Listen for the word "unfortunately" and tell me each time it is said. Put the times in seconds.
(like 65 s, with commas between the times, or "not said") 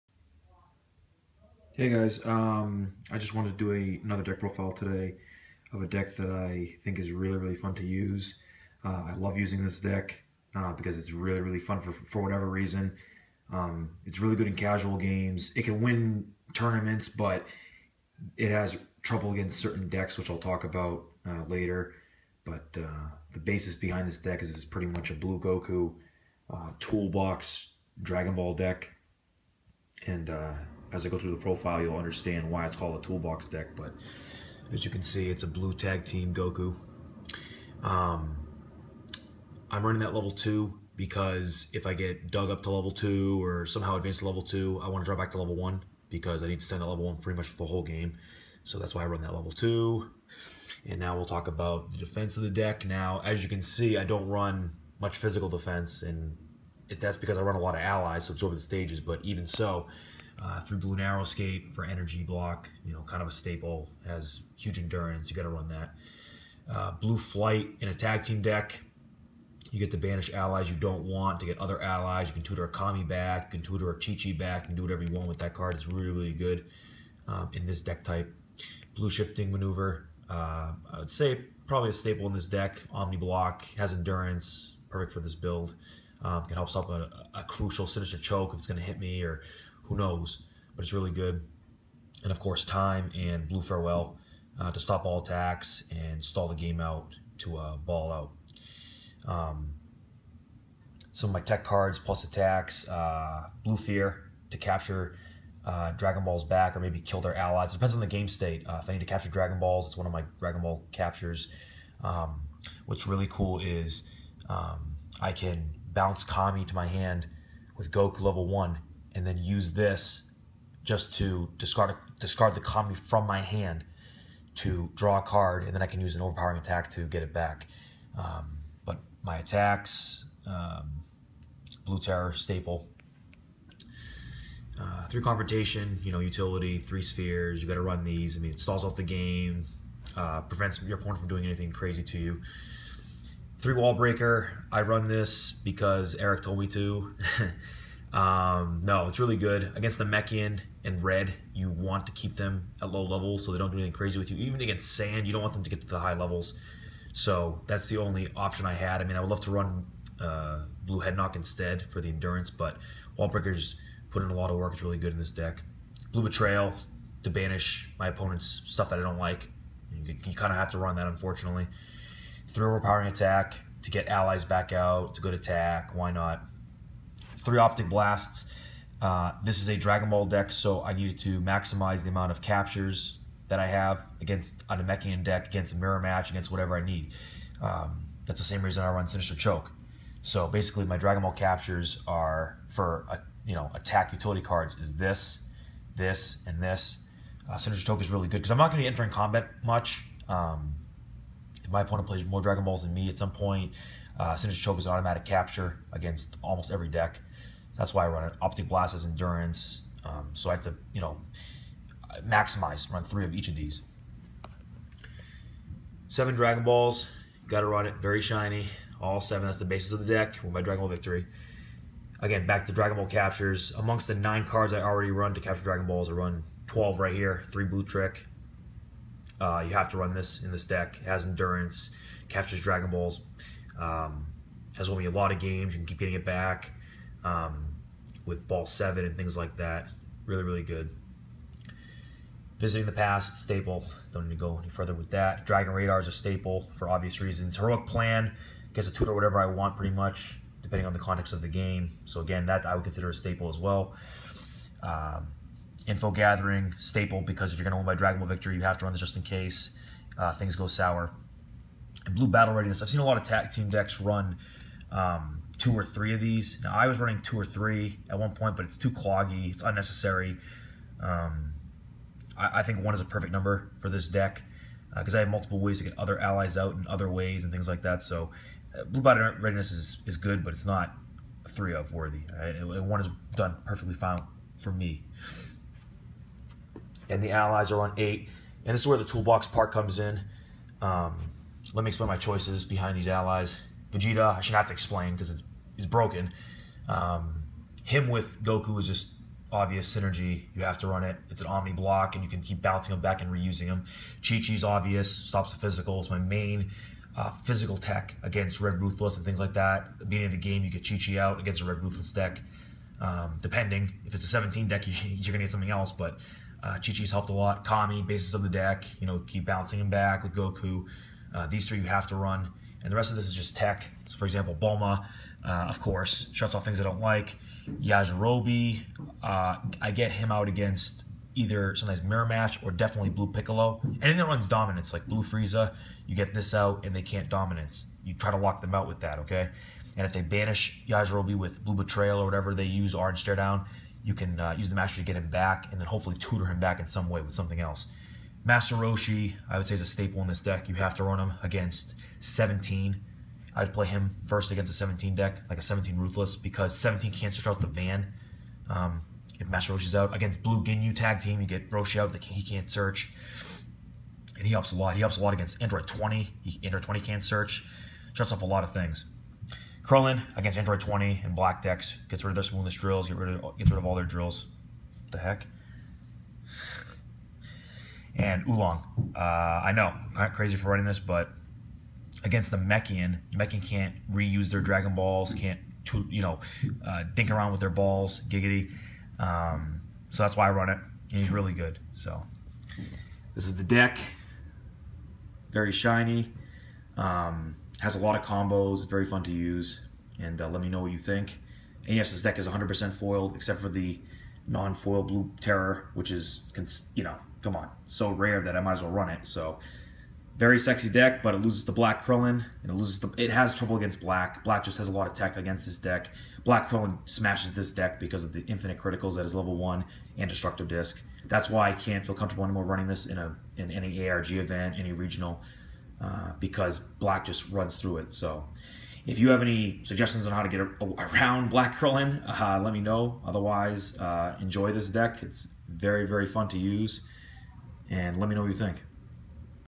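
171 s.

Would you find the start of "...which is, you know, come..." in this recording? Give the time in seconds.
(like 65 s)
405 s.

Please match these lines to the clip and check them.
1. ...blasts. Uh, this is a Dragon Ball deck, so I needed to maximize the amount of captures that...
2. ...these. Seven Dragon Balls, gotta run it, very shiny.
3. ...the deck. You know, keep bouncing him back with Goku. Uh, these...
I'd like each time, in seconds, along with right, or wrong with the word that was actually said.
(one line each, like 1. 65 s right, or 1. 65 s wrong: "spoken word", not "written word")
1. 177 s right
2. 213 s right
3. 318 s right.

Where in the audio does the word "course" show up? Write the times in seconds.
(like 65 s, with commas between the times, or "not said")
92 s, 325 s.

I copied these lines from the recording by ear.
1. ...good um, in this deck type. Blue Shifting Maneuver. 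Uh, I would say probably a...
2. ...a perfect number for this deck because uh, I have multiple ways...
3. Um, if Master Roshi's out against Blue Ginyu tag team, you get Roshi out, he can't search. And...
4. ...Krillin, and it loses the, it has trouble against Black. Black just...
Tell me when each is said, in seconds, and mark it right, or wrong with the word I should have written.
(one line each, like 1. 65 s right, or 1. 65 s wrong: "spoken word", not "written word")
1. 76 s right
2. 273 s right
3. 358 s right
4. 412 s right.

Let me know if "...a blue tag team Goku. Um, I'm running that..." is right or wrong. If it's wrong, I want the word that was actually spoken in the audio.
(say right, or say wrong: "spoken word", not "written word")
right.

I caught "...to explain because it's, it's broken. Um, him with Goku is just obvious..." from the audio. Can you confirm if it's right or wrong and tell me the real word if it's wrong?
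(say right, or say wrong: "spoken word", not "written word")
right.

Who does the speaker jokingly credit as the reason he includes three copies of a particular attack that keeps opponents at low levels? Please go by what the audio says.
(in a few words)
Eric.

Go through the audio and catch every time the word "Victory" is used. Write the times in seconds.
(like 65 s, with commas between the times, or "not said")
220 s, 258 s.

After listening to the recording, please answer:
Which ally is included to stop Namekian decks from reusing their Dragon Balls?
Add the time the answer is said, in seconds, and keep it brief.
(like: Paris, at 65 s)
Oolong, at 378 s.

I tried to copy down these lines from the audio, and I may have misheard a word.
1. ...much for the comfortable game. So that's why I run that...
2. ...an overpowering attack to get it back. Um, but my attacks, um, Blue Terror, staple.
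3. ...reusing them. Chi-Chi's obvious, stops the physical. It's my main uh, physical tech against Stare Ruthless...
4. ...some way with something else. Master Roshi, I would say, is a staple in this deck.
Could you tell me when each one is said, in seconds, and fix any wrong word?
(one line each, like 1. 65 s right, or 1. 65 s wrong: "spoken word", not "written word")
1. 47 s wrong: "whole", not "comfortable"
2. 126 s right
3. 303 s wrong: "Red", not "Stare"
4. 346 s right.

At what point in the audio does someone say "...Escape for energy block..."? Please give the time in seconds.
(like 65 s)
61 s.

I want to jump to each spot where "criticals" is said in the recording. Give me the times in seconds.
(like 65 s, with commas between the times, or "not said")
418 s.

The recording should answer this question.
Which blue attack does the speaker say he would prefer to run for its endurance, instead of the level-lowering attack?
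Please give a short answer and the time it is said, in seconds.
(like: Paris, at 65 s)
Blue Head Knock, at 160 s.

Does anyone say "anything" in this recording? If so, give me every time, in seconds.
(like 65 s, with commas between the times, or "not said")
141 s, 153 s, 334 s.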